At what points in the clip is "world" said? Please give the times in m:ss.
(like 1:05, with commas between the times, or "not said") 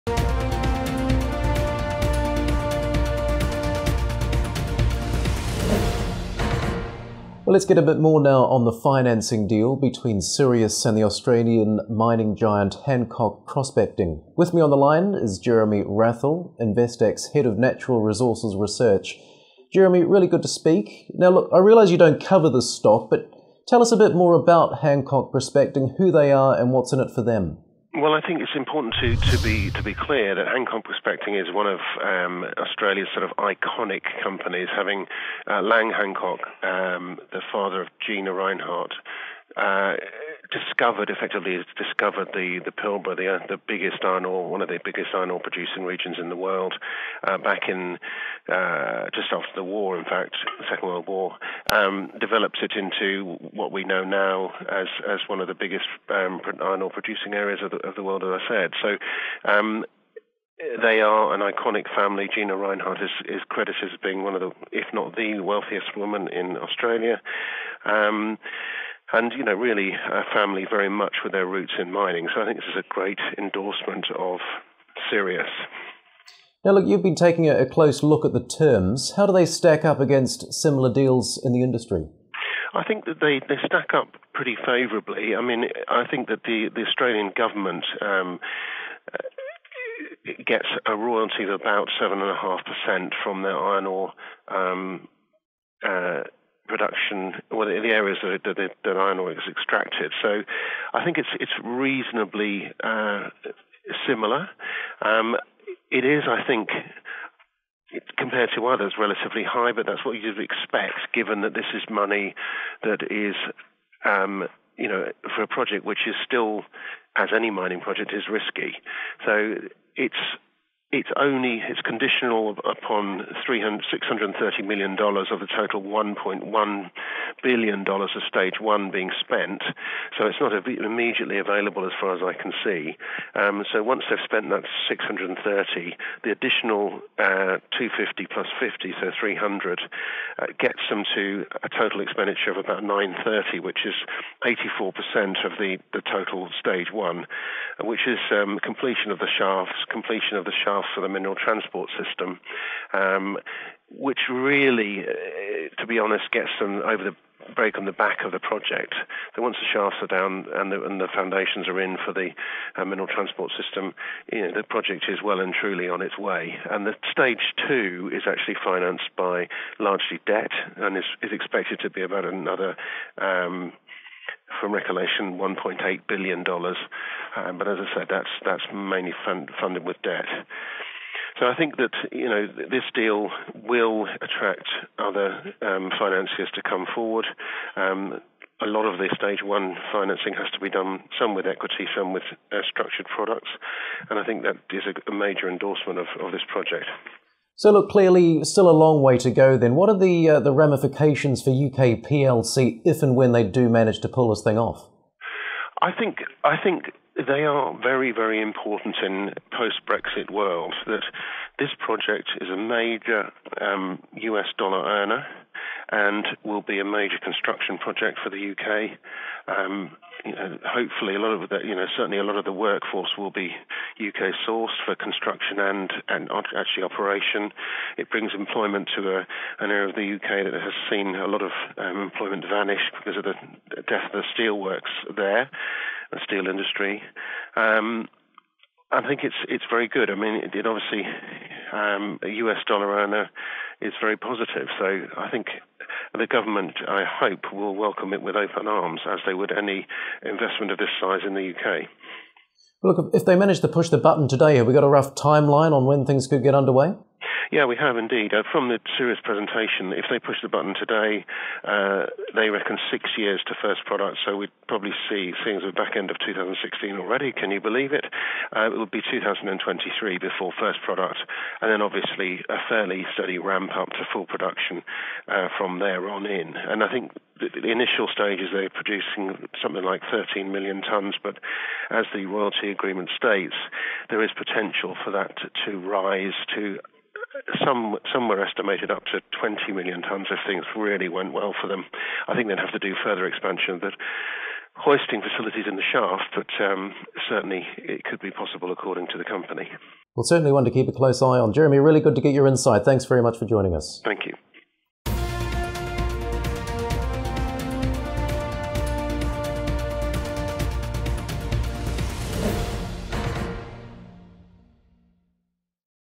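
0:46, 0:50, 0:58, 3:30.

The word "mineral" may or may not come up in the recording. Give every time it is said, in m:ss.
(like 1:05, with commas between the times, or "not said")
2:31, 2:42.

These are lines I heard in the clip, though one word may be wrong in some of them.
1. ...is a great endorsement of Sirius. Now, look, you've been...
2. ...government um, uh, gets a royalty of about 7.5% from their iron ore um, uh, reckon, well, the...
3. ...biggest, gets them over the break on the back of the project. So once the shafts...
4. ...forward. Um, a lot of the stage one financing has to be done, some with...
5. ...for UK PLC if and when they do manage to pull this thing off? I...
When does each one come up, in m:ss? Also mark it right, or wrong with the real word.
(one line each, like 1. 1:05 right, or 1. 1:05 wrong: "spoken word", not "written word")
1. 1:12 right
2. 1:27 wrong: "production", not "reckon"
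3. 2:35 wrong: "honest", not "biggest"
4. 3:06 right
5. 3:21 right.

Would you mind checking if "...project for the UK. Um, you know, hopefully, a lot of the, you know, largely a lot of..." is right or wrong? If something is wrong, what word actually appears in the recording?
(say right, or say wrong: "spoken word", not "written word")
wrong: "certainly", not "largely".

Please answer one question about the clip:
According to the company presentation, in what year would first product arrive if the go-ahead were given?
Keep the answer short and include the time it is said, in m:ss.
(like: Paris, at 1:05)
2023, at 4:29.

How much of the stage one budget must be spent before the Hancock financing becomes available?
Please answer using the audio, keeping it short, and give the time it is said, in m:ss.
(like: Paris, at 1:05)
$630 million, at 2:03.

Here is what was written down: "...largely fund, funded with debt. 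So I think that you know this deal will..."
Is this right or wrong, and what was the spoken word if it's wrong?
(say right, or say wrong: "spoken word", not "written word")
wrong: "mainly", not "largely".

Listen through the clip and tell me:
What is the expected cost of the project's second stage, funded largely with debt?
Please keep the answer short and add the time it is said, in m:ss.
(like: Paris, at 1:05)
$1.8 billion, at 2:55.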